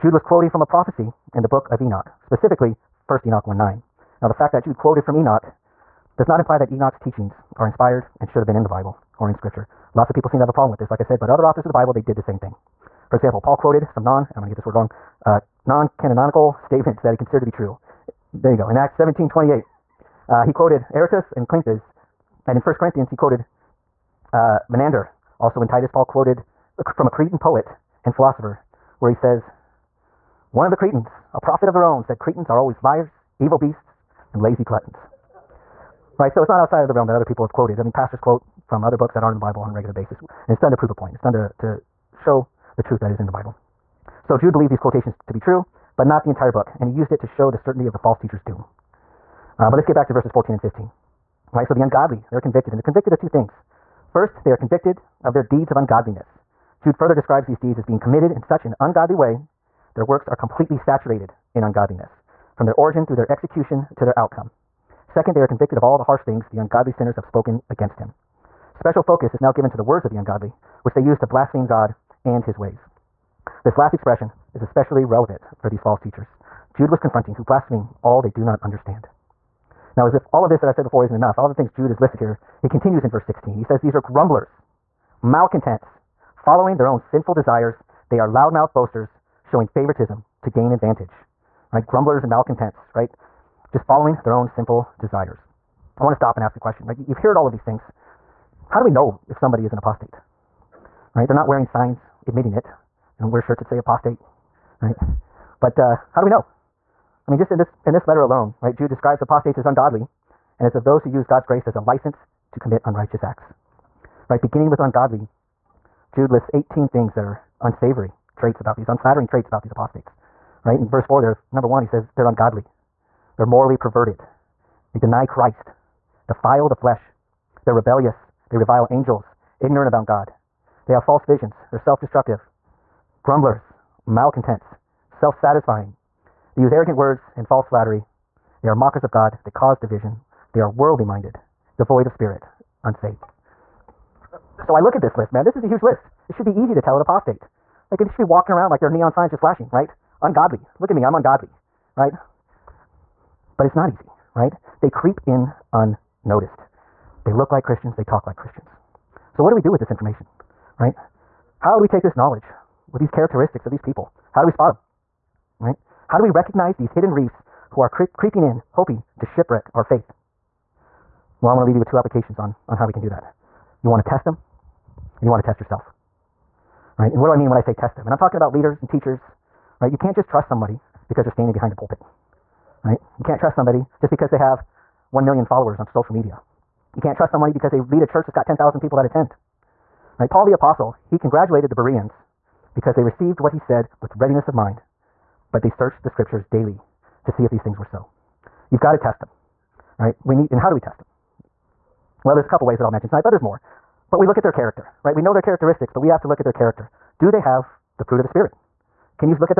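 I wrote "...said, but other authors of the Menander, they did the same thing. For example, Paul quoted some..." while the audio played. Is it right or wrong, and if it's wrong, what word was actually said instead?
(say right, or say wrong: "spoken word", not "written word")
wrong: "Bible", not "Menander".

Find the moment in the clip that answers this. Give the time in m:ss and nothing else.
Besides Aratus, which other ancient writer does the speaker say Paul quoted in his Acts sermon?
0:21.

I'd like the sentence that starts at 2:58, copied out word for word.
And I'm talking about leaders and teachers, right?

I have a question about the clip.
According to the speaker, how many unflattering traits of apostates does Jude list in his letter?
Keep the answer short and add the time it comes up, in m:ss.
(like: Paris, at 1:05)
18, at 1:56.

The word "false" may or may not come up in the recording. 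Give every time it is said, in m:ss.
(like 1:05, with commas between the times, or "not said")
0:47, 1:15, 2:11, 2:17.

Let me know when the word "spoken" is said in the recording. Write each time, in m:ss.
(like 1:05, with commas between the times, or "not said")
1:07.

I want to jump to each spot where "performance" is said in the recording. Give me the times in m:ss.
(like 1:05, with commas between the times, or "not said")
not said.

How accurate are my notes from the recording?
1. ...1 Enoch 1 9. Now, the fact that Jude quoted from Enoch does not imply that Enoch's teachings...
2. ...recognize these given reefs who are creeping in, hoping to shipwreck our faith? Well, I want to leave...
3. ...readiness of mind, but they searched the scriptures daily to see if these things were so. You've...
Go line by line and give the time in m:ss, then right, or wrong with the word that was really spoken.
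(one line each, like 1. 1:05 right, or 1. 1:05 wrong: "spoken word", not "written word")
1. 0:03 right
2. 2:46 wrong: "hidden", not "given"
3. 3:14 right.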